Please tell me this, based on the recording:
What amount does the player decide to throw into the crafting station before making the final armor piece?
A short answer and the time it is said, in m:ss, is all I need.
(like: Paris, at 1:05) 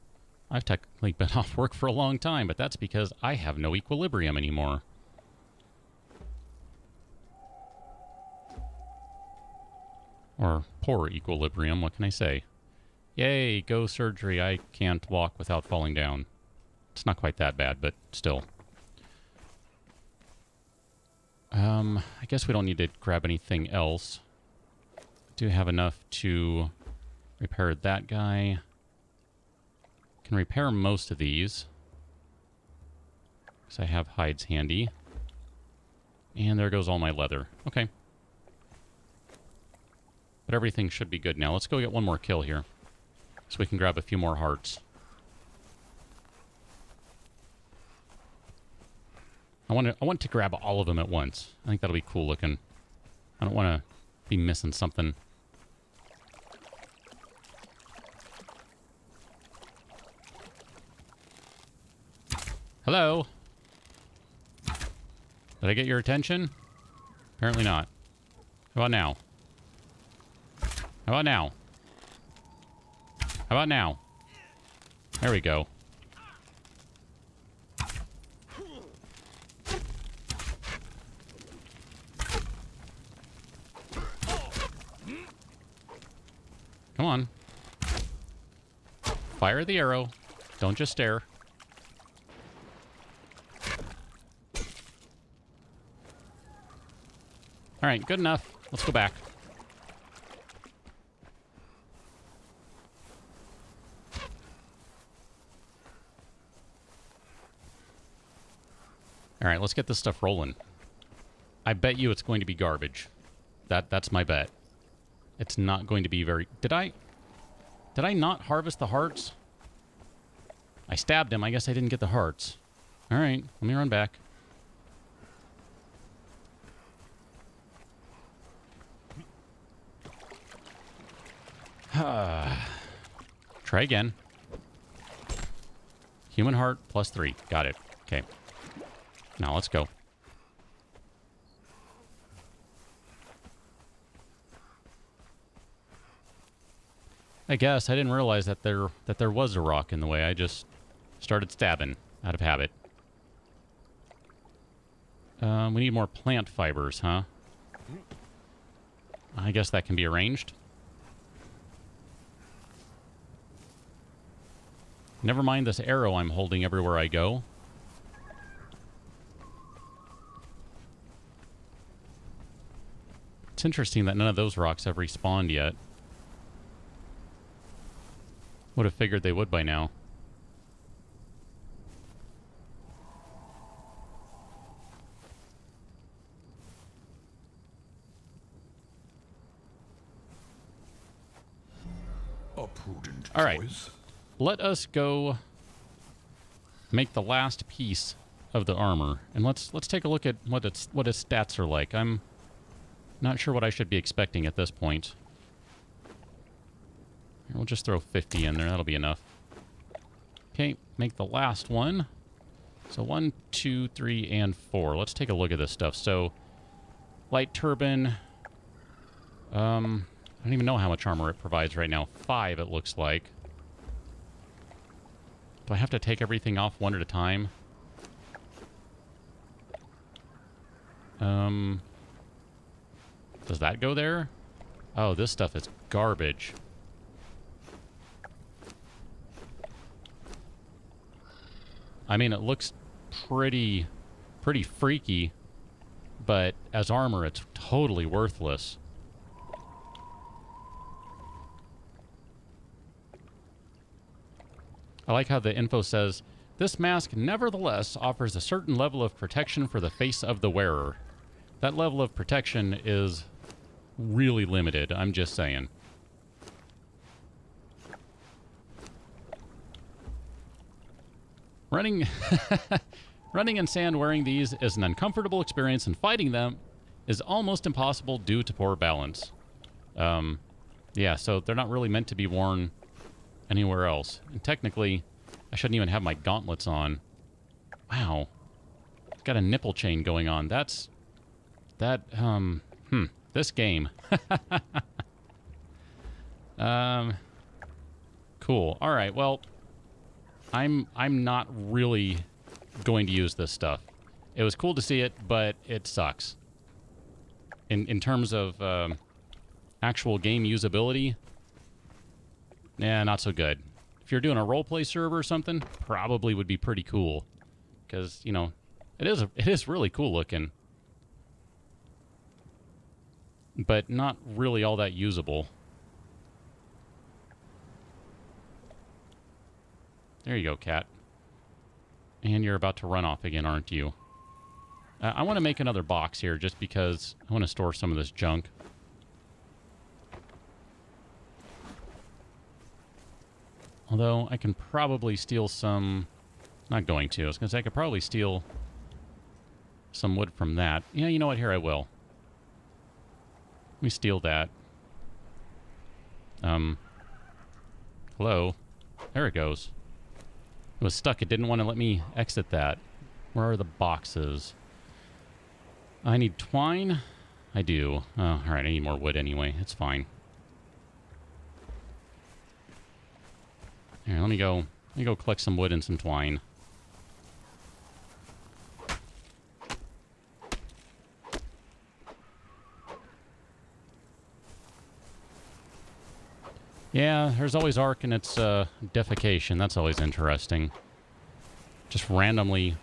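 50, at 3:27.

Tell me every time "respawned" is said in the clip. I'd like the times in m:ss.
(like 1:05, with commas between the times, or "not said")
2:54.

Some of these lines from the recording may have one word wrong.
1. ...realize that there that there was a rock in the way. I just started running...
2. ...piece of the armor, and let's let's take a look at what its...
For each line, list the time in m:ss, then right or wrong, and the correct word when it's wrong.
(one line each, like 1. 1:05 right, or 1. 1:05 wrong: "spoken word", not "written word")
1. 2:28 wrong: "stabbing", not "running"
2. 3:17 right.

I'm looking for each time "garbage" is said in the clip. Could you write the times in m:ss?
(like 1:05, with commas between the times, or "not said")
1:52, 3:55.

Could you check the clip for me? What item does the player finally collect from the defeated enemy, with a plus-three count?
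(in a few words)
Human heart.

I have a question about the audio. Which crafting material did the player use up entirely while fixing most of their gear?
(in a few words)
leather.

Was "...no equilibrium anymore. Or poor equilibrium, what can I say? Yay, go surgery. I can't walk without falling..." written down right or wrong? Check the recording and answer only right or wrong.
right.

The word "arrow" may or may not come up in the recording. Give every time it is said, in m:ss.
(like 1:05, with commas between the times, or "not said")
1:29, 2:45.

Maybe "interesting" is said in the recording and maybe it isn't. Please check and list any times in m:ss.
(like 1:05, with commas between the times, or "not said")
2:53, 6:29.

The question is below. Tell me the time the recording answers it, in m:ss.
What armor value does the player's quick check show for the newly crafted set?
3:42.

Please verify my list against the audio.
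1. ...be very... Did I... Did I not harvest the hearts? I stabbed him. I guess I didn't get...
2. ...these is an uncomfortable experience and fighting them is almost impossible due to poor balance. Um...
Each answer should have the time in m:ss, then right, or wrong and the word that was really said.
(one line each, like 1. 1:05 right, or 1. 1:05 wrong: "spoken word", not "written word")
1. 1:56 right
2. 4:34 right.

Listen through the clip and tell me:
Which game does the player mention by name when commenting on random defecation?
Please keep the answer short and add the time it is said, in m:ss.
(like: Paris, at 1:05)
Ark, at 6:27.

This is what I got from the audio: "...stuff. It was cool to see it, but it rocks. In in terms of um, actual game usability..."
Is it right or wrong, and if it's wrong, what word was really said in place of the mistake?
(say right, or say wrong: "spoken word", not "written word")
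wrong: "sucks", not "rocks".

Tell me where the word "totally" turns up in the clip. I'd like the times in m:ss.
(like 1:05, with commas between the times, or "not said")
4:07.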